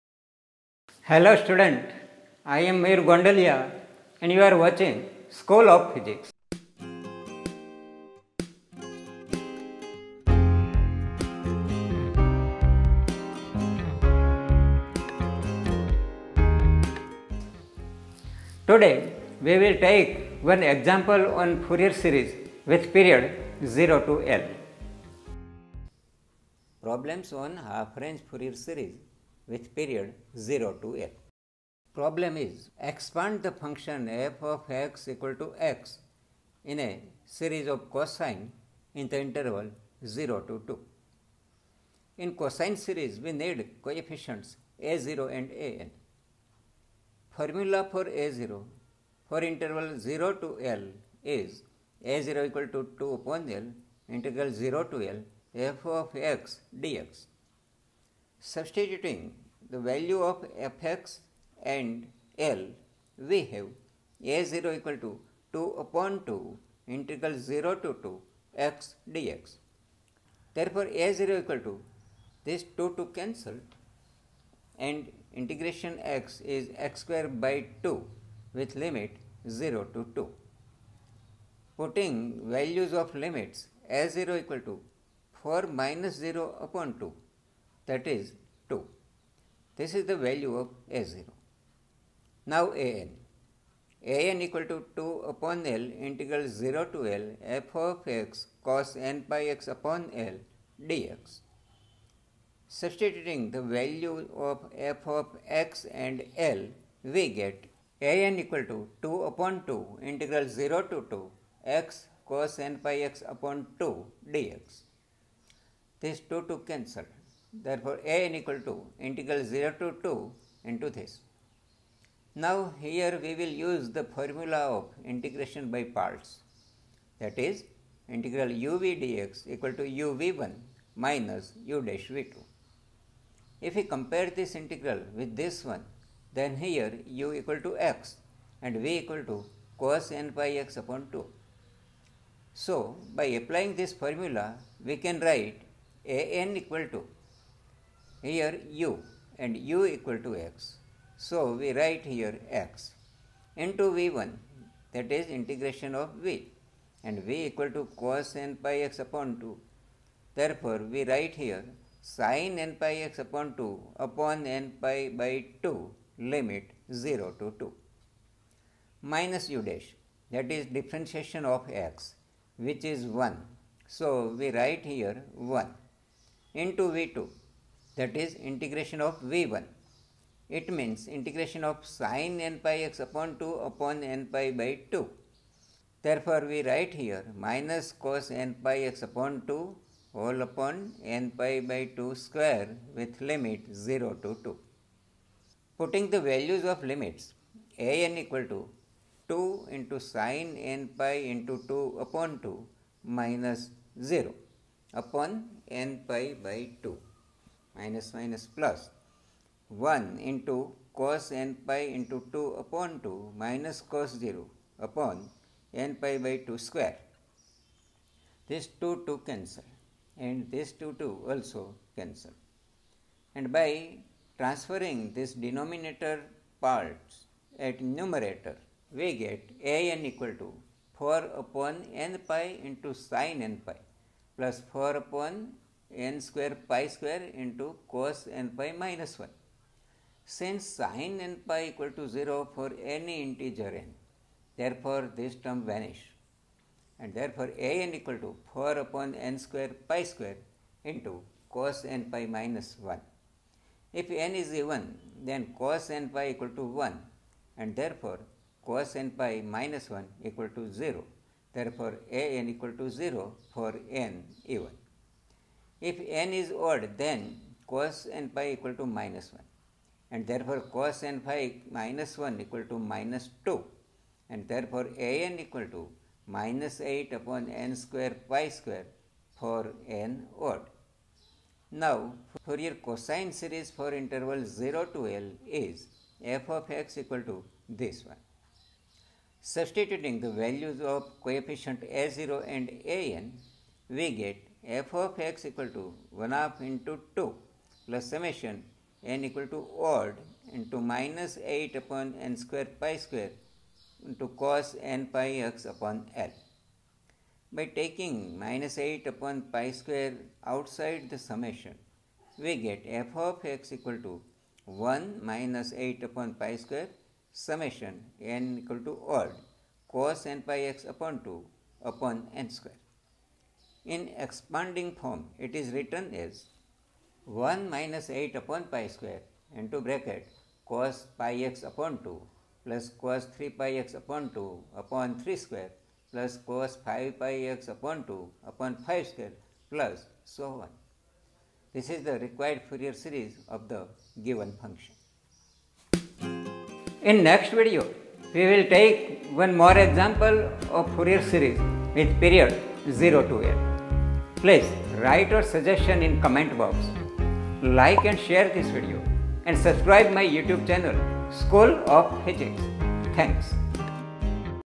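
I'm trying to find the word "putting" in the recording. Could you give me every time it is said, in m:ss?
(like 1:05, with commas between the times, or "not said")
1:21, 3:15.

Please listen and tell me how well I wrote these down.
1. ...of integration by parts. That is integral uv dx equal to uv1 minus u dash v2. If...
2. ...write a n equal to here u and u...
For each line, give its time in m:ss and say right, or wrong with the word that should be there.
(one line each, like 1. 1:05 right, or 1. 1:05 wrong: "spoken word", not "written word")
1. 2:04 right
2. 2:25 right.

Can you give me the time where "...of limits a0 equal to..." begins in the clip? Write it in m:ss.
1:22.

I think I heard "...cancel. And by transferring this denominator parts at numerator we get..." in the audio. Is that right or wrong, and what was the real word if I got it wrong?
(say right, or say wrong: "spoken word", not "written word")
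right.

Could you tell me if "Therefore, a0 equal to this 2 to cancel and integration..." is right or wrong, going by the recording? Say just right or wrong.
right.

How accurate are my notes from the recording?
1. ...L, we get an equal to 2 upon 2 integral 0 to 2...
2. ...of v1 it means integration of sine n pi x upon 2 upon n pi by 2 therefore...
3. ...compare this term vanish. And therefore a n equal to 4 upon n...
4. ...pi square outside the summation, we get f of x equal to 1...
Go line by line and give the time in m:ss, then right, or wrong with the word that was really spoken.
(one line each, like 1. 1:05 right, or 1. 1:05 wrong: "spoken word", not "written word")
1. 1:46 right
2. 2:59 right
3. 4:04 wrong: "therefore", not "compare"
4. 5:09 right.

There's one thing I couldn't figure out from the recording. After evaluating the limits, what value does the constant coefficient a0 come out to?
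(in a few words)
2.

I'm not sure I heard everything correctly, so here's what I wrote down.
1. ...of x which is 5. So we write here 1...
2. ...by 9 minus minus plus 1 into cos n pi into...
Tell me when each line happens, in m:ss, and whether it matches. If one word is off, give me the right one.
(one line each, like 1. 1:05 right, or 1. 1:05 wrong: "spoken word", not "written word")
1. 2:51 wrong: "1", not "5"
2. 3:26 wrong: "2", not "9".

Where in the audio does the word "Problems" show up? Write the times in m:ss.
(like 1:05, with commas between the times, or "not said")
0:26, 0:31.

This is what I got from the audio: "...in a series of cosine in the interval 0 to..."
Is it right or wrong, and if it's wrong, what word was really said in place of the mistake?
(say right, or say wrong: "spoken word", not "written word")
right.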